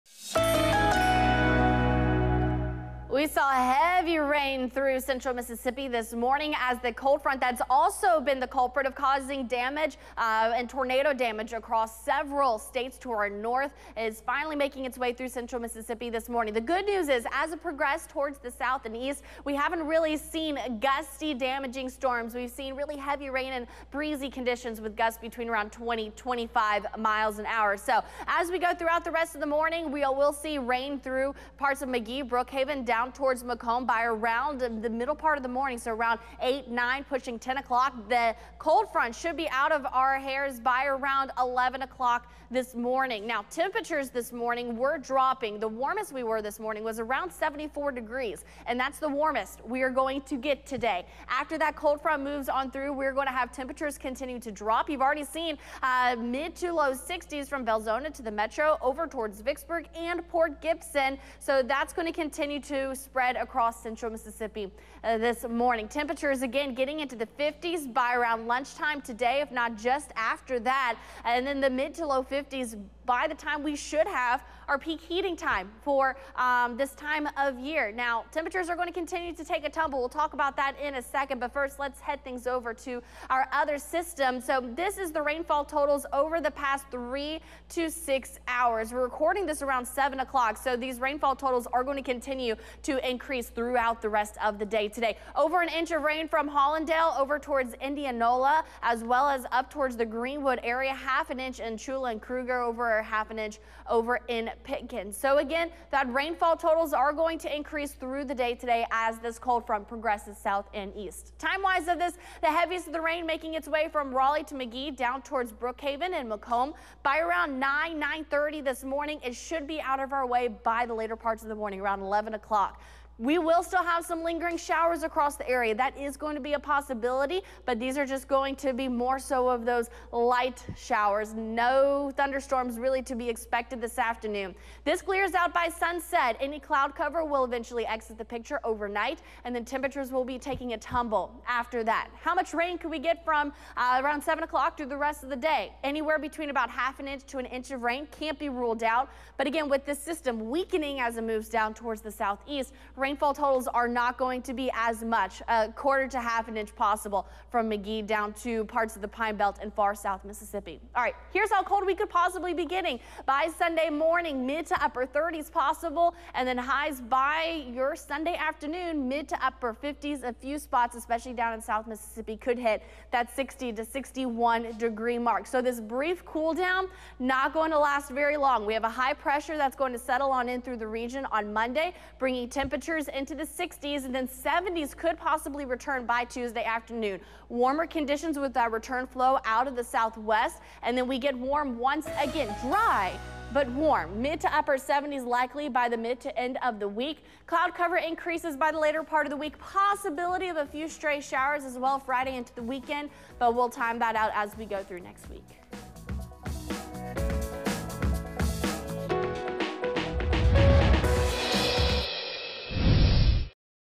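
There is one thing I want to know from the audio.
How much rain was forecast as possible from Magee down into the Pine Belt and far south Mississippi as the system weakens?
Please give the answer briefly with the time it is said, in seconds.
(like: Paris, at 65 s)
a quarter to half an inch, at 155 s.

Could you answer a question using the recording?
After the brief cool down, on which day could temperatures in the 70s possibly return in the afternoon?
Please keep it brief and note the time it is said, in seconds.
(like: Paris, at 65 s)
Tuesday, at 186 s.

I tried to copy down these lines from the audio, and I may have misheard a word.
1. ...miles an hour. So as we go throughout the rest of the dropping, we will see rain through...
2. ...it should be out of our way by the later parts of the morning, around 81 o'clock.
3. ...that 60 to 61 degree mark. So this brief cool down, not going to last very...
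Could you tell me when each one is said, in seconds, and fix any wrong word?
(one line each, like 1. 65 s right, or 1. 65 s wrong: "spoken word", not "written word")
1. 26 s wrong: "morning", not "dropping"
2. 119 s wrong: "11", not "81"
3. 173 s right.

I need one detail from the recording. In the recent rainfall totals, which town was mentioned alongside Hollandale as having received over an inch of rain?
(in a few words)
Indianola.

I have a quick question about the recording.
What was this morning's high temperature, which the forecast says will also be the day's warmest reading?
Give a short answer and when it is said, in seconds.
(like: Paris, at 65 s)
74 degrees, at 47 s.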